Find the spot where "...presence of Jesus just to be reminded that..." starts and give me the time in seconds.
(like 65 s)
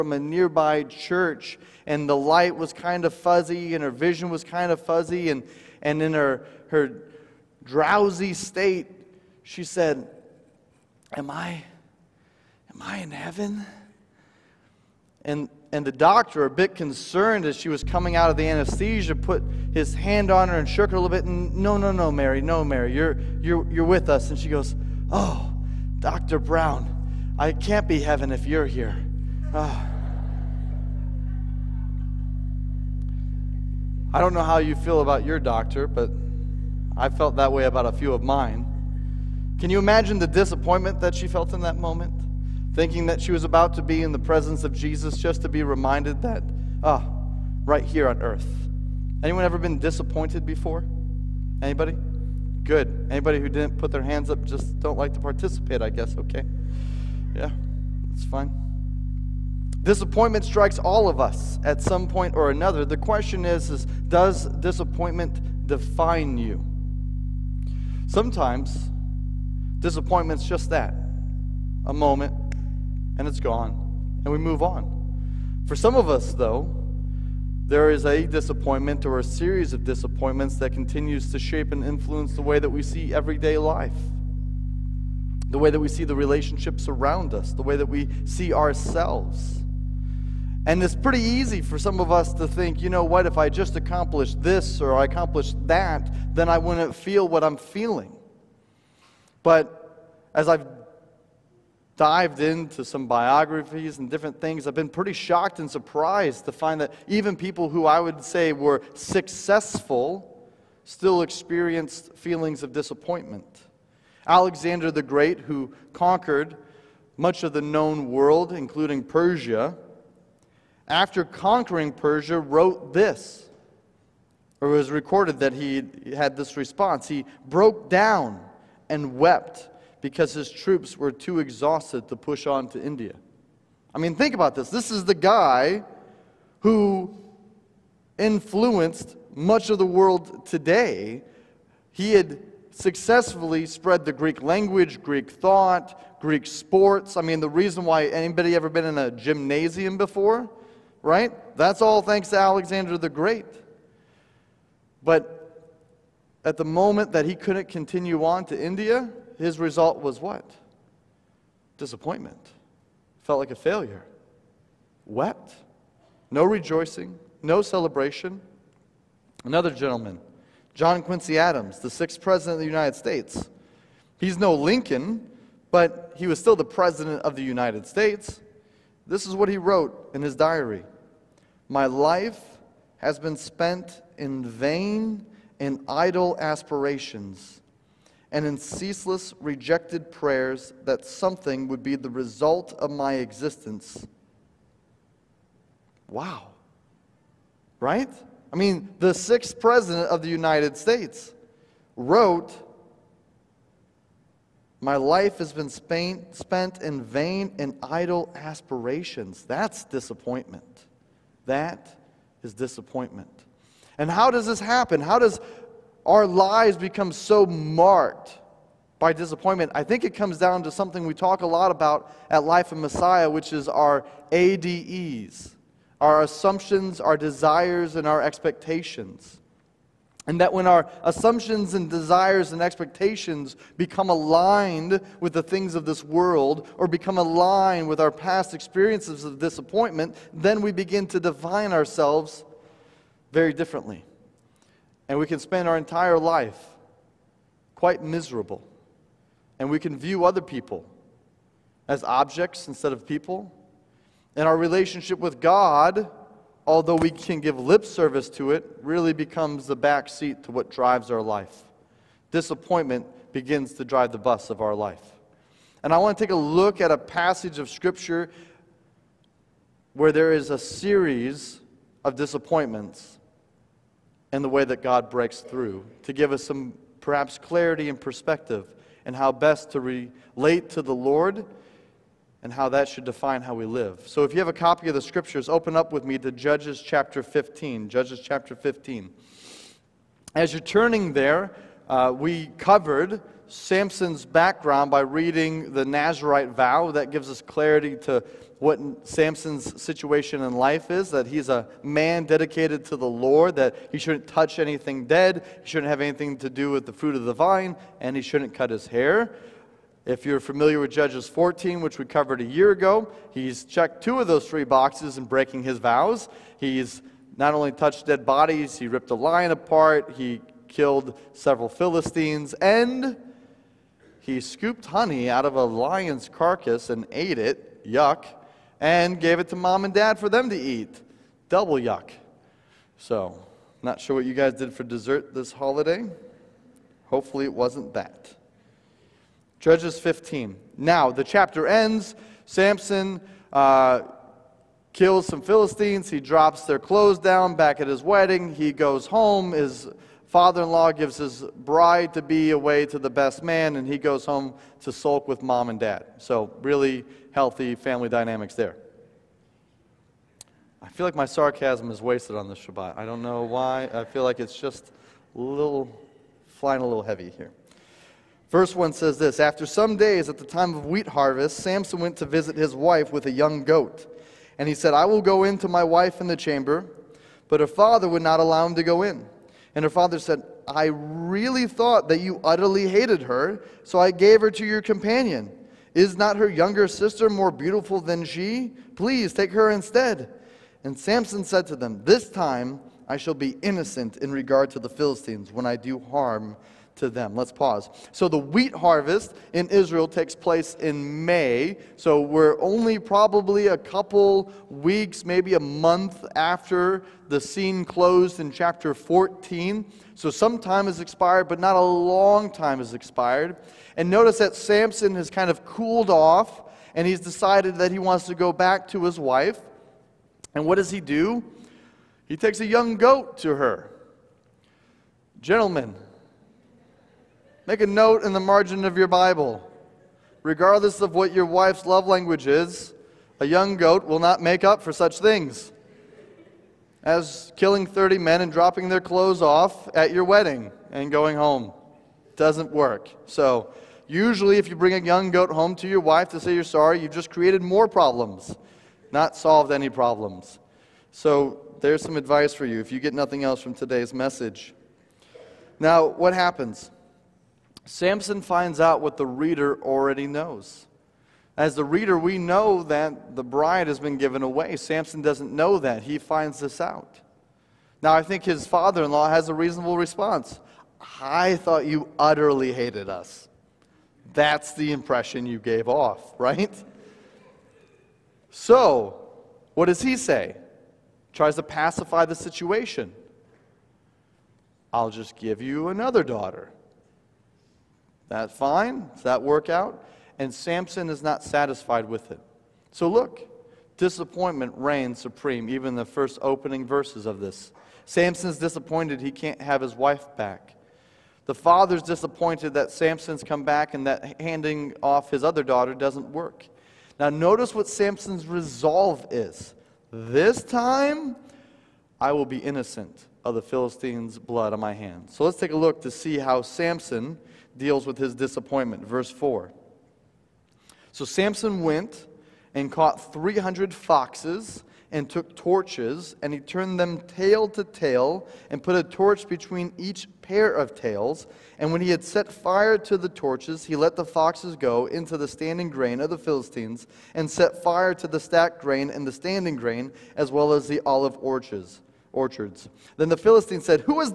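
44 s.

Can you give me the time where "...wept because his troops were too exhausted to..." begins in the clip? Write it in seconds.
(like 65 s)
129 s.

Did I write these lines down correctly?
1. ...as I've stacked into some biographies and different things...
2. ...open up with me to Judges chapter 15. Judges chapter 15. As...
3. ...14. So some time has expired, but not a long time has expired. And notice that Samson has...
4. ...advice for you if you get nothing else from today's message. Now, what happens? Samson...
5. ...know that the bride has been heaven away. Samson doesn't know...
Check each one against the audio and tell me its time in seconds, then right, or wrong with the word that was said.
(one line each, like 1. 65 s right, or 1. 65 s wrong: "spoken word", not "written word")
1. 100 s wrong: "dived", not "stacked"
2. 285 s right
3. 408 s right
4. 452 s right
5. 462 s wrong: "given", not "heaven".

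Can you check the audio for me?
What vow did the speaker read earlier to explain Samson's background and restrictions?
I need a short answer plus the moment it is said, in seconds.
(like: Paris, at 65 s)
Nazarite vow, at 295 s.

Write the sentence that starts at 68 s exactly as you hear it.
Sometimes disappointment's just that a moment, and it's gone, and we move on.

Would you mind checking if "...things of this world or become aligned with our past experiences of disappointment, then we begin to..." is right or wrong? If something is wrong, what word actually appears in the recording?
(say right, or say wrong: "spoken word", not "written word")
right.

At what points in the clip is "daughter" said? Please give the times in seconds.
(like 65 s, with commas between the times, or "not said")
486 s, 505 s.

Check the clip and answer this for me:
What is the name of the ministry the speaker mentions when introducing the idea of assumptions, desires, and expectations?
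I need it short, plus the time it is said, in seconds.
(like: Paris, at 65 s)
Life in Messiah, at 222 s.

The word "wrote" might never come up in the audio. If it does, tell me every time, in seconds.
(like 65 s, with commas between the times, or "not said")
122 s, 179 s, 201 s.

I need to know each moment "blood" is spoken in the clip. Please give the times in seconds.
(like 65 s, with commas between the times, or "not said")
514 s.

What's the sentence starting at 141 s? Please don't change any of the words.
He had successfully spread the Greek language, Greek thought, Greek sports.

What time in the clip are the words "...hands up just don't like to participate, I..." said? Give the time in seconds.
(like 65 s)
54 s.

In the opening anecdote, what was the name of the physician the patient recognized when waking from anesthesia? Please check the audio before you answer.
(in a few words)
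Dr. Brown.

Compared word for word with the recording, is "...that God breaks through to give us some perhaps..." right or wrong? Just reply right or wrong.
right.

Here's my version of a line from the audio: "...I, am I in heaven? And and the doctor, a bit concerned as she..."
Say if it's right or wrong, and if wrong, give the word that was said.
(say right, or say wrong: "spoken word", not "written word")
right.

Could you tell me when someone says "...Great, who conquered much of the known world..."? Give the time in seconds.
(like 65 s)
115 s.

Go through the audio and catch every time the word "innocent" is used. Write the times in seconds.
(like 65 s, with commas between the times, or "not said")
393 s, 512 s.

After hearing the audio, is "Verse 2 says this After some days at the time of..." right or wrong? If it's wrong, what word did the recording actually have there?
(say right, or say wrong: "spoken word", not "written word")
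wrong: "1", not "2".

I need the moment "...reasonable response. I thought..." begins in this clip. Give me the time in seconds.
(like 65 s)
469 s.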